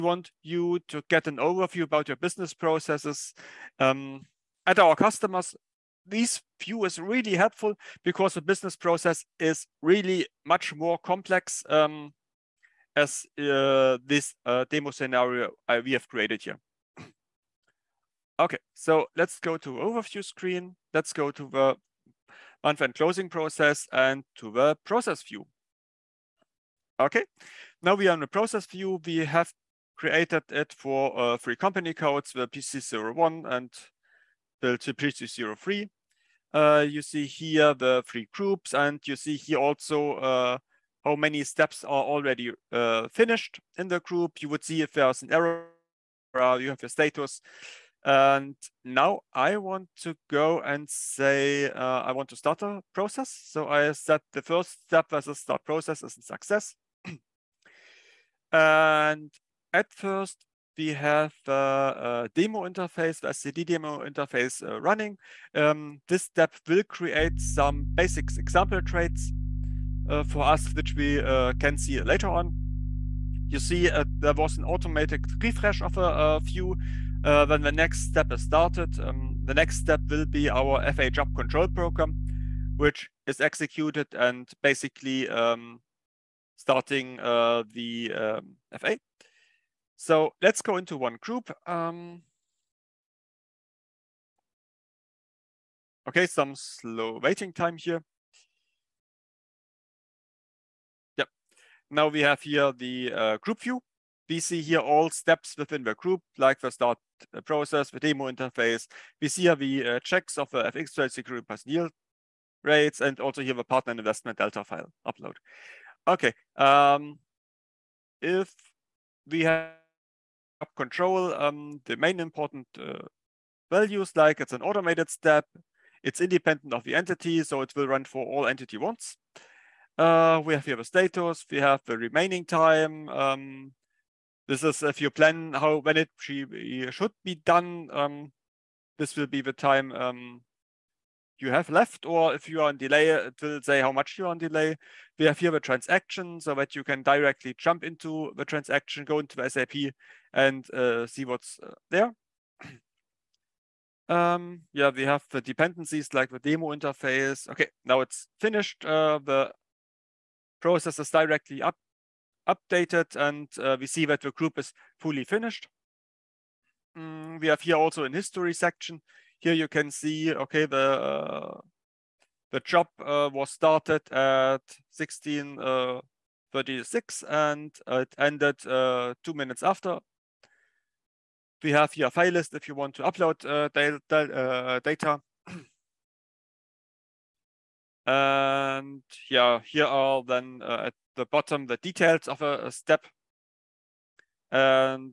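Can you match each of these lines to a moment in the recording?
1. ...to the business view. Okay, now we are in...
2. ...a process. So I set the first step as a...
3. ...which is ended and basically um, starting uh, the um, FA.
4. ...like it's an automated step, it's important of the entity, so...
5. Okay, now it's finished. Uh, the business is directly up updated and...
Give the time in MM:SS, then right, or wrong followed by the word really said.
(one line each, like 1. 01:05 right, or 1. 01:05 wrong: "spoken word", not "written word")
1. 00:24 wrong: "process", not "business"
2. 00:52 right
3. 01:22 wrong: "executed", not "ended"
4. 02:04 wrong: "independent", not "important"
5. 02:37 wrong: "process", not "business".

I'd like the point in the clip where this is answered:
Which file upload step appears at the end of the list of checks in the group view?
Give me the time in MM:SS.
01:53.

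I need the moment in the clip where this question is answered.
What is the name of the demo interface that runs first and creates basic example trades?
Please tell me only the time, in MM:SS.
01:03.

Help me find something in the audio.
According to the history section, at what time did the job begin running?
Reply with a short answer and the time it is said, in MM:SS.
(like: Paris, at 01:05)
16.36, at 02:54.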